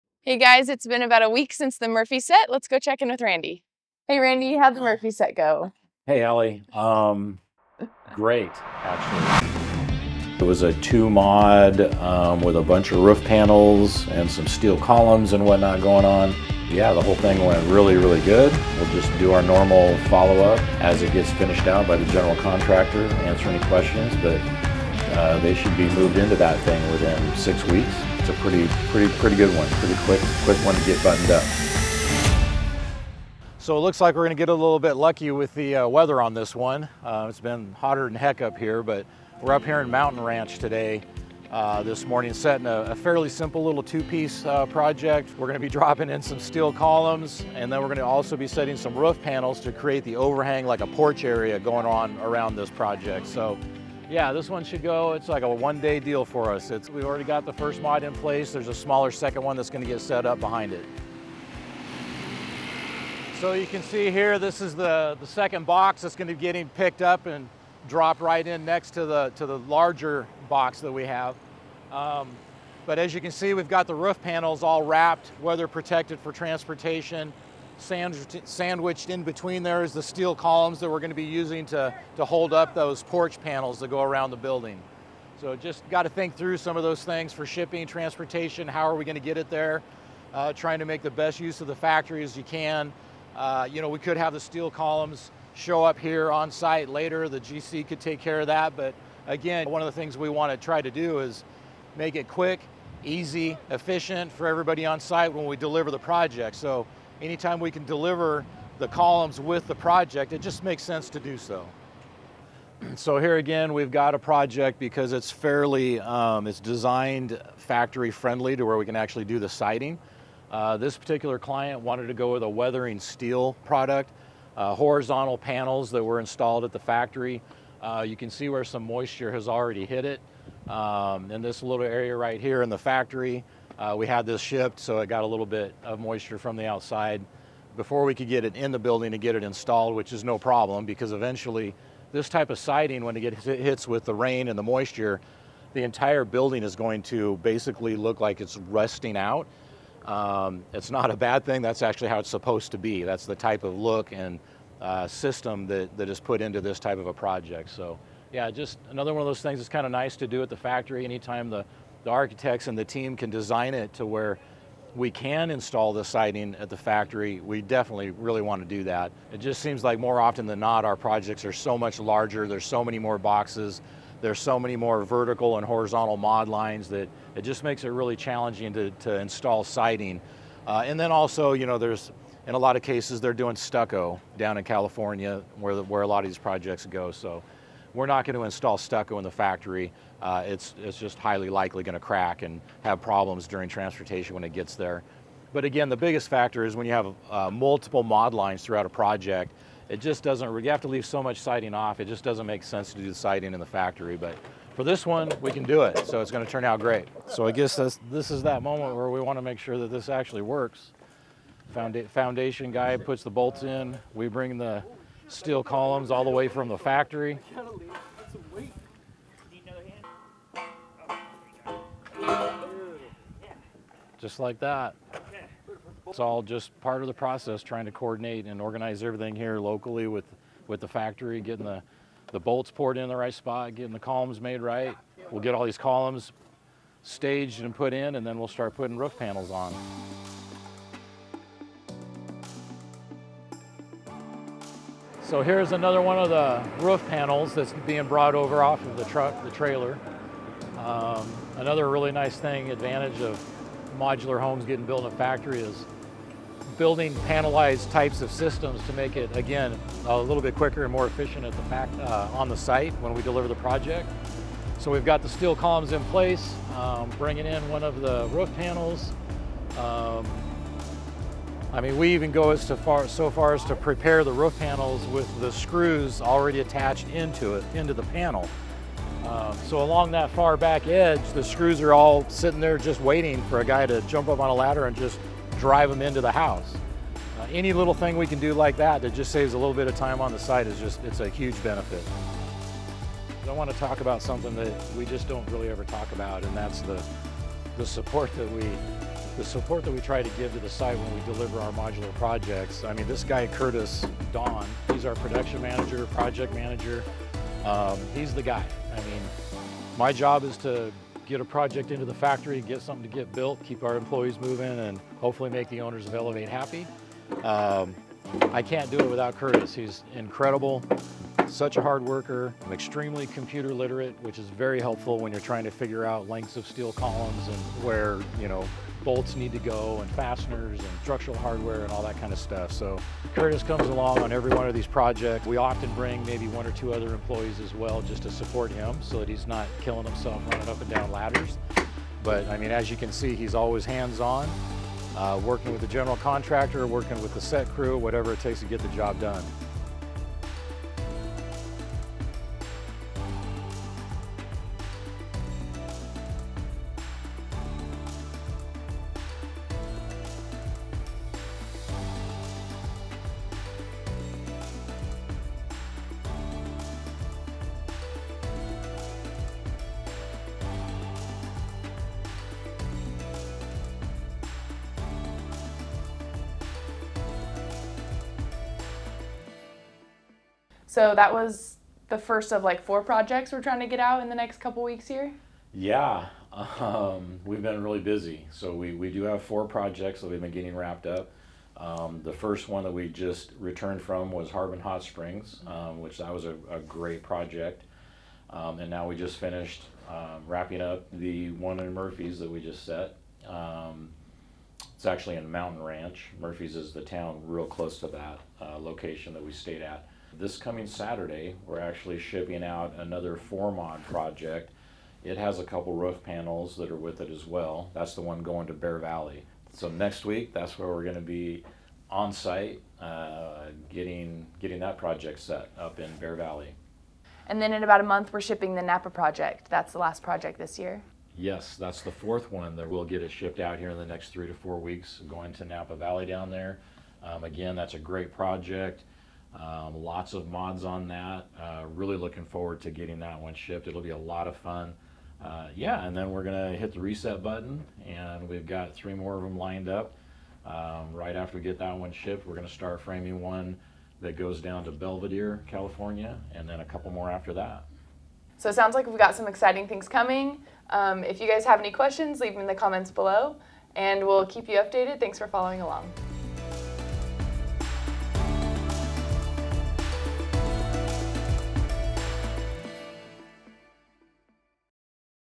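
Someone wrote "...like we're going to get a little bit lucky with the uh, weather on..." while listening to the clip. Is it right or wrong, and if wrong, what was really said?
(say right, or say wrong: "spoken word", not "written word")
right.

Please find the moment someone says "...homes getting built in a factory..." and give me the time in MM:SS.
04:14.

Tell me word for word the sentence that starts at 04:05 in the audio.
So here's another one of the roof panels that's being brought over off of the truck, the trailer.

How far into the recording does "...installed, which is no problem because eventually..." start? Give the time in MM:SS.
02:19.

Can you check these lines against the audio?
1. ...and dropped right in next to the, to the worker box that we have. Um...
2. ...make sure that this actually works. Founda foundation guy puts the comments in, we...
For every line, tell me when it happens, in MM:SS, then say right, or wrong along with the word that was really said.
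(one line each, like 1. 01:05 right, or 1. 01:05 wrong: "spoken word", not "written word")
1. 01:07 wrong: "larger", not "worker"
2. 03:29 wrong: "bolts", not "comments".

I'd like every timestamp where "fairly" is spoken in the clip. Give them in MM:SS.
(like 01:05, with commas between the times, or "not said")
00:42, 01:55.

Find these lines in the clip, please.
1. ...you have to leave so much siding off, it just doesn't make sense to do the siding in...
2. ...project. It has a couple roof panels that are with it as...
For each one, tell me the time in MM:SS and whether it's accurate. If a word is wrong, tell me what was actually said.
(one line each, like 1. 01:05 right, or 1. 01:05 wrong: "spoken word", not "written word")
1. 03:20 right
2. 06:54 right.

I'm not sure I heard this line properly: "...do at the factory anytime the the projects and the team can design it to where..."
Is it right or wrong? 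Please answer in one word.
wrong.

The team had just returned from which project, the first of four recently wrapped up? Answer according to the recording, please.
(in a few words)
Harbin Hot Springs.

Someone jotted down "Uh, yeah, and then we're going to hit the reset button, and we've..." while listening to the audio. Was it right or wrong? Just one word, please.
right.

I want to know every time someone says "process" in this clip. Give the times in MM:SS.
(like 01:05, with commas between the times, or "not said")
03:47.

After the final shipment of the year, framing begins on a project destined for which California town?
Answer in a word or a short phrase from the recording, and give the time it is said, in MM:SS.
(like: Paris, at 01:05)
Belvedere, at 07:34.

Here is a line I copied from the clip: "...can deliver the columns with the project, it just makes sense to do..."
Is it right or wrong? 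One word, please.
right.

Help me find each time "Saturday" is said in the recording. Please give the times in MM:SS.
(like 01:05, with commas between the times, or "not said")
06:50.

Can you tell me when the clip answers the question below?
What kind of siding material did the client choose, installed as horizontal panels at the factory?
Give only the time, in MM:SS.
02:02.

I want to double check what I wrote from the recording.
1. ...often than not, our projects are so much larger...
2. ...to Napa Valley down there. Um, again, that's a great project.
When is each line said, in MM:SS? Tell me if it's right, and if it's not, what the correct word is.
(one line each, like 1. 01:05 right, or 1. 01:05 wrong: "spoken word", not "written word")
1. 02:50 right
2. 07:15 right.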